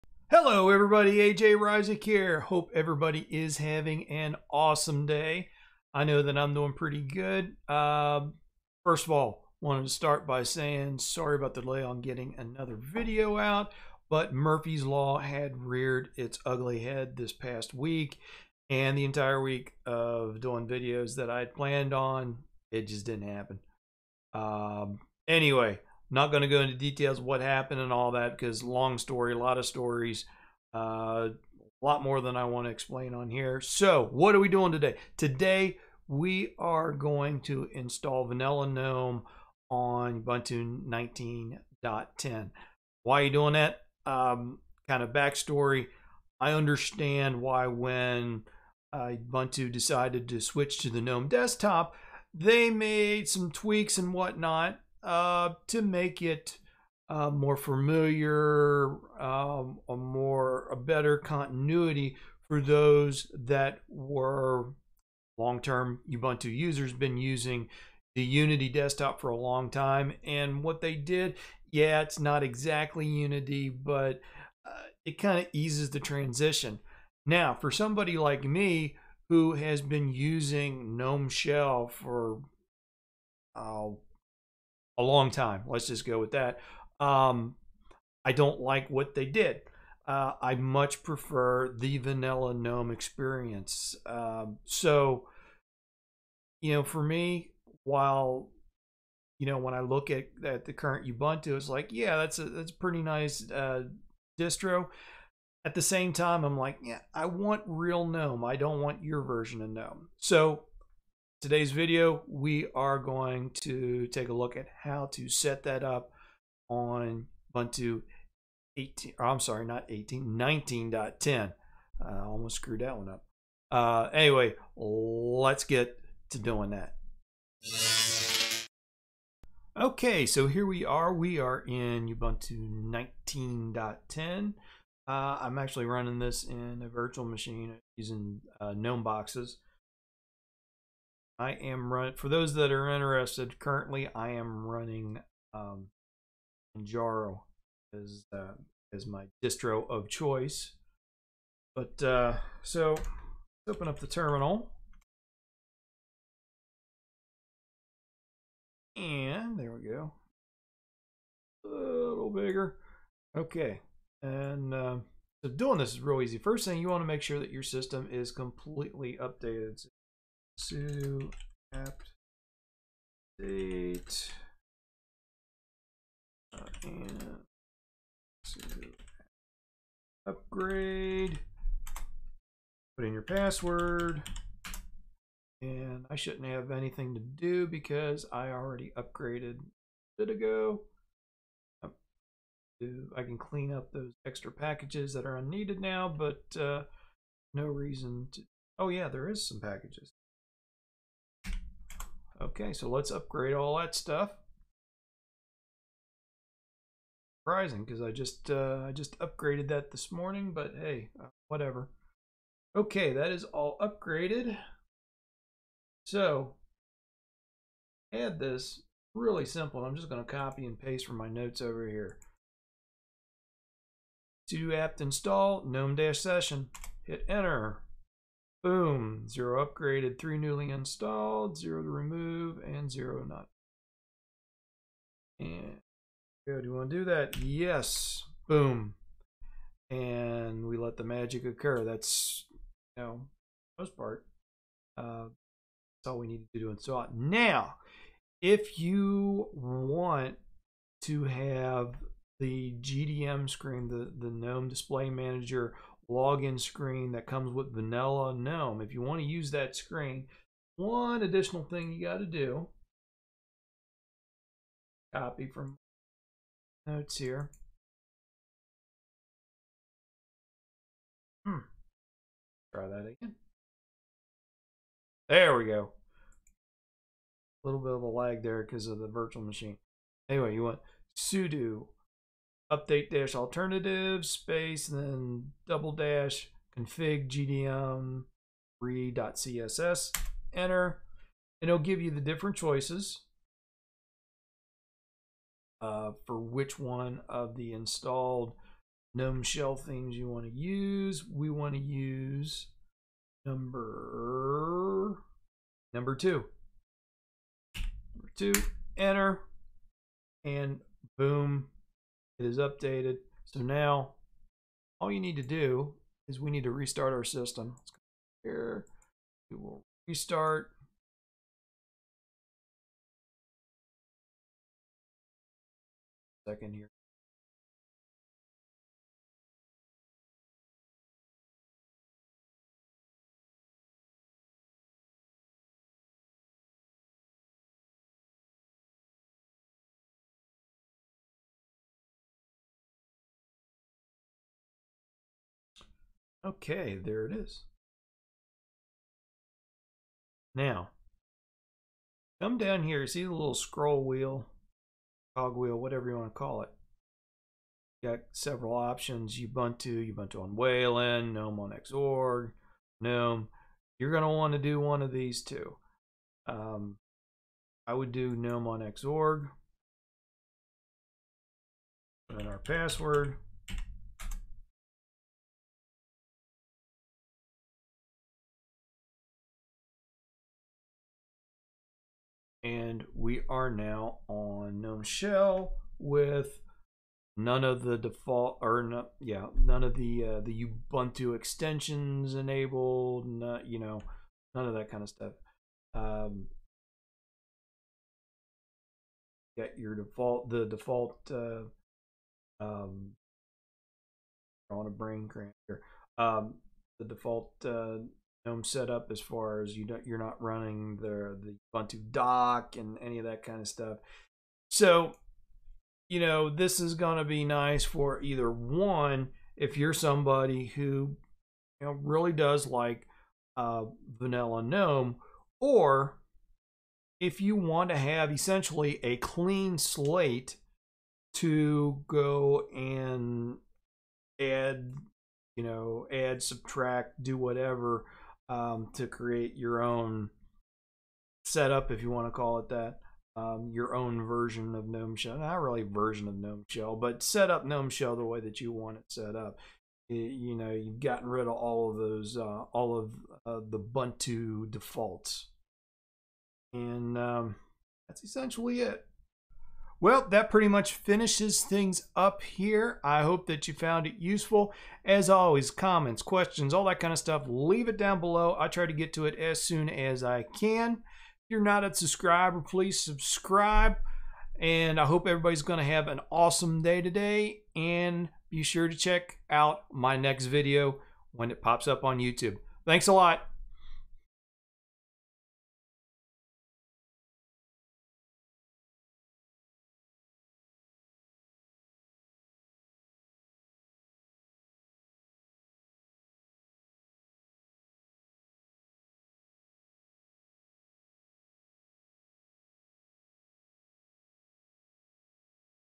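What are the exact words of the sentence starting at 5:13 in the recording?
So now all you need to do is we need to restart our system.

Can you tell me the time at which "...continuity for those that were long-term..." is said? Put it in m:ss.
1:01.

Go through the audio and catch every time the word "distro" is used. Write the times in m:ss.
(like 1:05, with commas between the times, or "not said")
1:44, 2:29.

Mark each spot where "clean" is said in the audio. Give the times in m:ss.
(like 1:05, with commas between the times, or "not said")
3:13, 7:09.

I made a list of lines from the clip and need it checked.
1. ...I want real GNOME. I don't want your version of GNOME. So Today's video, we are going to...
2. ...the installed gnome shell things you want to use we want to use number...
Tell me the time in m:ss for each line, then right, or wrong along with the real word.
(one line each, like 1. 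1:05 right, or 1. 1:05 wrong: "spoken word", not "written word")
1. 1:47 right
2. 4:57 right.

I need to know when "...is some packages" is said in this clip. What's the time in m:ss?
3:19.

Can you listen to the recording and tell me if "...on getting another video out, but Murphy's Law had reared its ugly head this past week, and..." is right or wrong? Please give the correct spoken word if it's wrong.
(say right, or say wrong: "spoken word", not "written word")
right.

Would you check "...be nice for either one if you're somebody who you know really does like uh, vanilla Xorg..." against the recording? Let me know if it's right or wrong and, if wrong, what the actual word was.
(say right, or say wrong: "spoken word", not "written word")
wrong: "GNOME", not "Xorg".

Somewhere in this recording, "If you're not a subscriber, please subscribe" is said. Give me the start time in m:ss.
7:50.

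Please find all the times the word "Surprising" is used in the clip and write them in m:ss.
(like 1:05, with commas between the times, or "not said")
3:27.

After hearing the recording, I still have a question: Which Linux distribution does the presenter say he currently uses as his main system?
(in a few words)
Manjaro.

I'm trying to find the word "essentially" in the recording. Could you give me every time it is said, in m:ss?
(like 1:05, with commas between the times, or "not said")
7:08, 7:38.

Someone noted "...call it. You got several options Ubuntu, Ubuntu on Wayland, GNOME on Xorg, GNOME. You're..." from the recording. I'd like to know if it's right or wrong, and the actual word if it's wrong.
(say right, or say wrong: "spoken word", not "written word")
right.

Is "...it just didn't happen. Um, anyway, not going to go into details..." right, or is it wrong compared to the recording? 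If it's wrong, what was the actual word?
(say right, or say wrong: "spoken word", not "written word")
right.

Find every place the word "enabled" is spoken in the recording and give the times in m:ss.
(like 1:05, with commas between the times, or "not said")
6:32.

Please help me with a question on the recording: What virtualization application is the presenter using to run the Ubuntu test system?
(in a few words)
GNOME Boxes.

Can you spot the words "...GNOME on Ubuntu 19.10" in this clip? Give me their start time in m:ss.
0:38.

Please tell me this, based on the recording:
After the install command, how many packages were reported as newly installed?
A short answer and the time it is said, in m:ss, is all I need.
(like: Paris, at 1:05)
3, at 3:50.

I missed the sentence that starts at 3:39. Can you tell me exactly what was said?
I'm just going to copy and paste from my notes over here.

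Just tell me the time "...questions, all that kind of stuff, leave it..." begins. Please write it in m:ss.
7:46.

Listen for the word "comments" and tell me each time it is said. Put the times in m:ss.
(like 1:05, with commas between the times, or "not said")
7:45.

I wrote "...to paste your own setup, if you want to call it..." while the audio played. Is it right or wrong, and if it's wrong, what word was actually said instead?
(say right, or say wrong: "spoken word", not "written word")
wrong: "create", not "paste".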